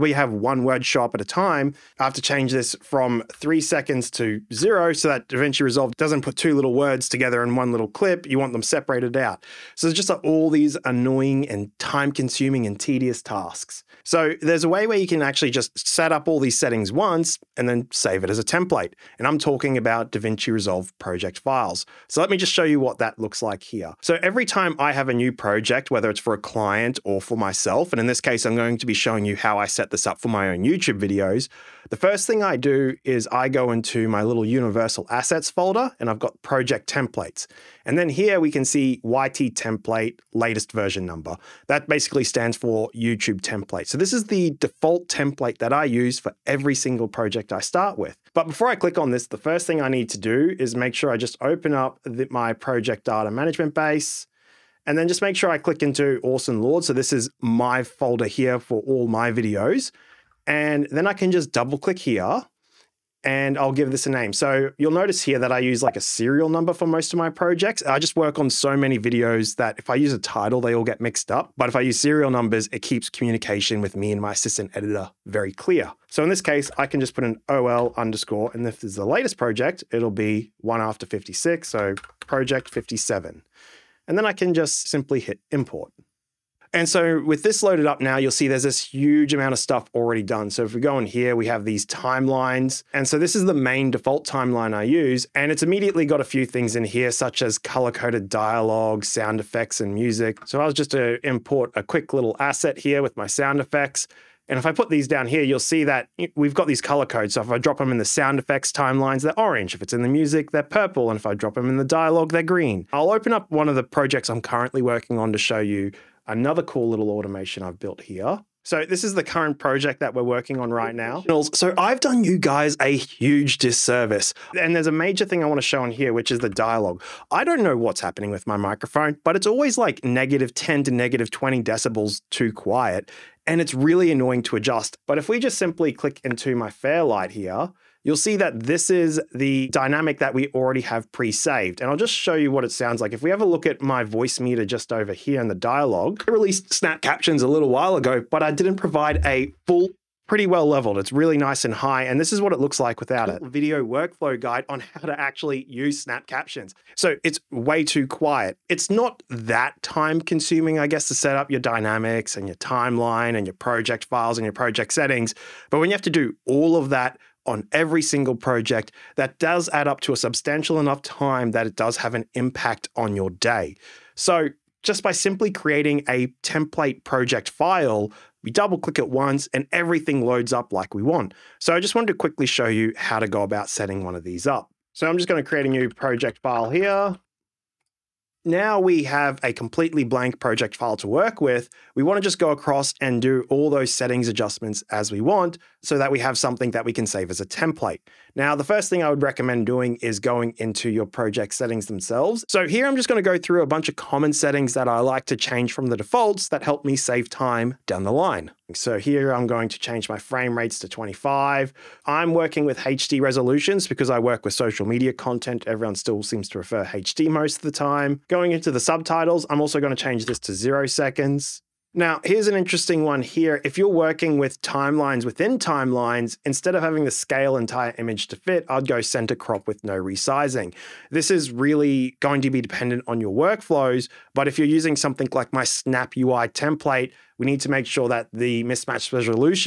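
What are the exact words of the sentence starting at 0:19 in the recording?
And I'm talking about DaVinci Resolve project files.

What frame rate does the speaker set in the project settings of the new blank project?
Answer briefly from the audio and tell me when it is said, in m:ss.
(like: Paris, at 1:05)
25, at 3:30.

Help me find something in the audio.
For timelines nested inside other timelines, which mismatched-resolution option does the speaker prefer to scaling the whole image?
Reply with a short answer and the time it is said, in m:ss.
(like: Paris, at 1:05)
Center crop with no resizing, at 3:49.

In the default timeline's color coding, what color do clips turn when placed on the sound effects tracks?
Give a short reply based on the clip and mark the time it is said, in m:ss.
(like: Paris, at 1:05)
Orange, at 1:49.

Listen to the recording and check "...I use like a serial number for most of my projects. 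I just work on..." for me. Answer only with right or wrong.
right.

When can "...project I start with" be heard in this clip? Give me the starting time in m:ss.
0:47.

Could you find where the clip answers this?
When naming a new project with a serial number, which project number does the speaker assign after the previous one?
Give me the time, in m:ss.
1:22.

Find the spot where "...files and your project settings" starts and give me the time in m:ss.
2:44.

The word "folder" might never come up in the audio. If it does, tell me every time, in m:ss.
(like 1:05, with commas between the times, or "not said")
0:35, 0:57.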